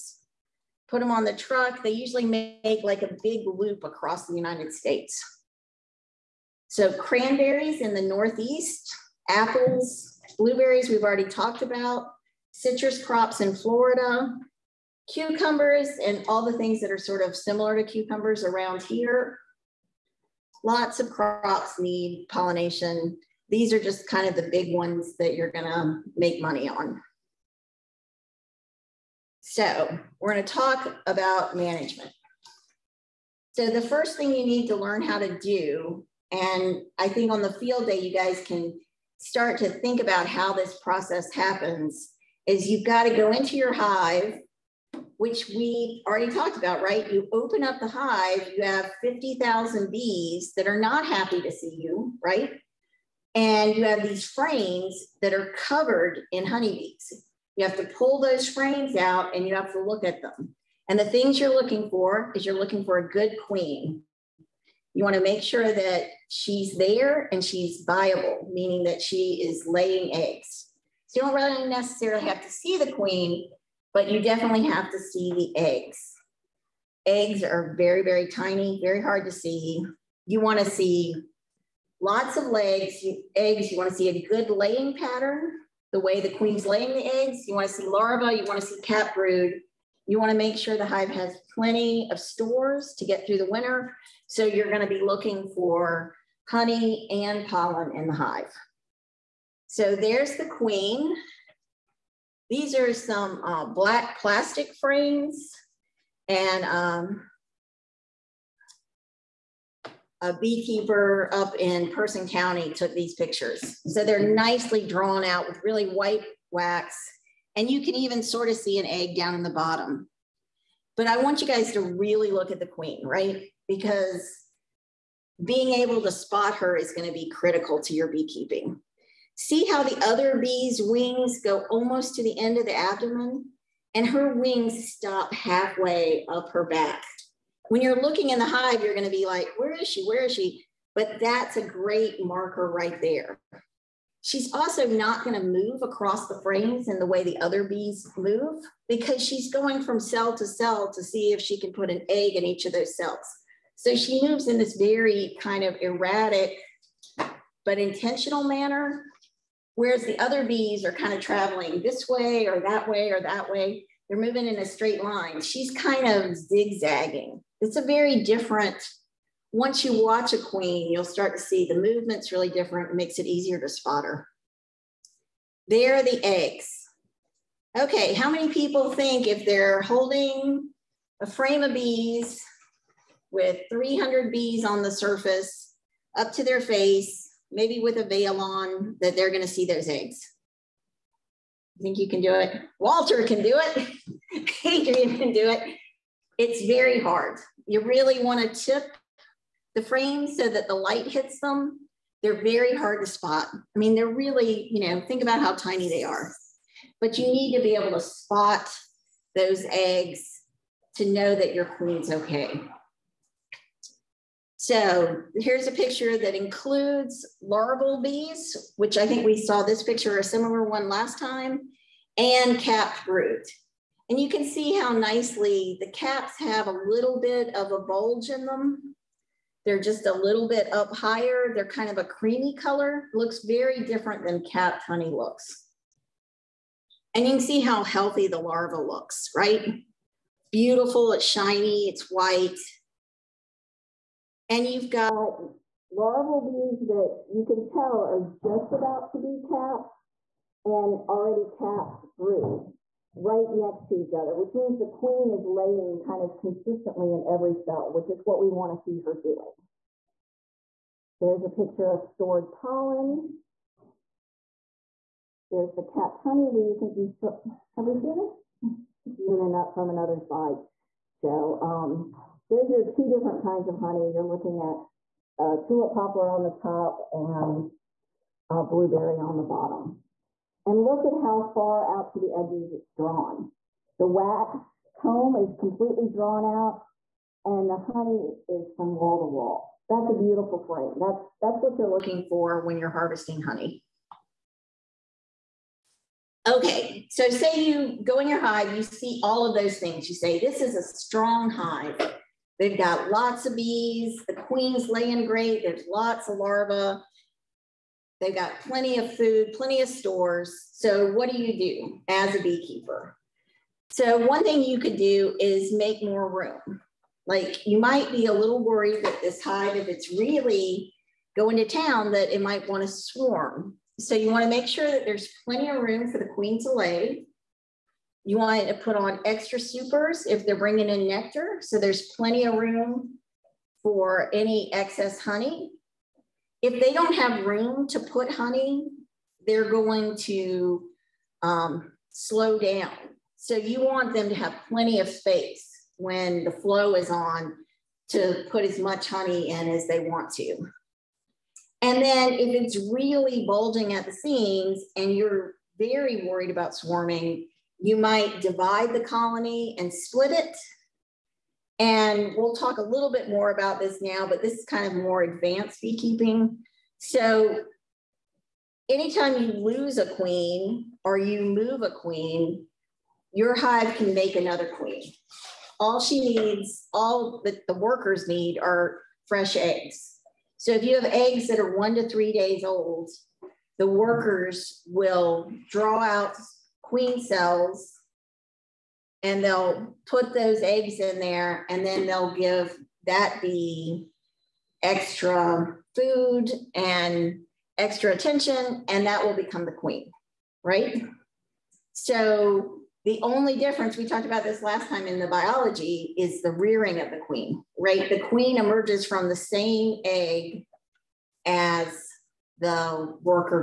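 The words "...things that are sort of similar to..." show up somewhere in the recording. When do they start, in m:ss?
0:16.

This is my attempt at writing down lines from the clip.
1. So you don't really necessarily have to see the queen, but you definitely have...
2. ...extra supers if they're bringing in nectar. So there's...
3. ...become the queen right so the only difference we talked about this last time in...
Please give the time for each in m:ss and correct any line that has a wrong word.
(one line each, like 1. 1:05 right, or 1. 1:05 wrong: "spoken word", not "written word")
1. 1:11 right
2. 5:29 right
3. 6:39 right.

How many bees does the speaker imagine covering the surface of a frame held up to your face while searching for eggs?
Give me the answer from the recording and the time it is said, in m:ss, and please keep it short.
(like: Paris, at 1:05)
300, at 3:03.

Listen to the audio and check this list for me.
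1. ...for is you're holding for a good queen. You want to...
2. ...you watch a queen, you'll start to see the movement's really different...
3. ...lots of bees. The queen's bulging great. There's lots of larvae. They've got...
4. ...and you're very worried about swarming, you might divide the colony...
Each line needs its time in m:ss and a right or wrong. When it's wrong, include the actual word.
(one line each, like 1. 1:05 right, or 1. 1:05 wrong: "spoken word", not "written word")
1. 1:01 wrong: "looking", not "holding"
2. 2:49 right
3. 5:03 wrong: "laying", not "bulging"
4. 5:54 right.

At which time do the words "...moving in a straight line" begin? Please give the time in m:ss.
2:44.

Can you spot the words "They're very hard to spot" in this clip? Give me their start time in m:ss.
3:22.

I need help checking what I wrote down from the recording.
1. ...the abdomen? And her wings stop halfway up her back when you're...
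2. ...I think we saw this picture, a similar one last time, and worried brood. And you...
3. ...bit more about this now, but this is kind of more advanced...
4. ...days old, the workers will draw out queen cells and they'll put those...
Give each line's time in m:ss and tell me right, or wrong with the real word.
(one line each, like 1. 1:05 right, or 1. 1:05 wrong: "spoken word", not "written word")
1. 2:12 right
2. 3:38 wrong: "capped", not "worried"
3. 6:03 right
4. 6:22 right.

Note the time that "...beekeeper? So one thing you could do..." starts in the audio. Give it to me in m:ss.
5:12.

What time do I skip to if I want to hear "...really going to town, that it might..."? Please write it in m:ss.
5:20.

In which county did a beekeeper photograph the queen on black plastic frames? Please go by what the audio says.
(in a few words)
Person County.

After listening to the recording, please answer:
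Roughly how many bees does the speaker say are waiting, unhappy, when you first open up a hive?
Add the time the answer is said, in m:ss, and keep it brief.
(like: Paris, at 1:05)
50,000, at 0:49.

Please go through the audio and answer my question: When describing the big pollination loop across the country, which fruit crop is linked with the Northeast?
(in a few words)
Cranberries.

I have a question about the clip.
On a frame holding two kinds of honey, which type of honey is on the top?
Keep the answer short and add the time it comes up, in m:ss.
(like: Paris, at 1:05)
Tulip poplar, at 4:35.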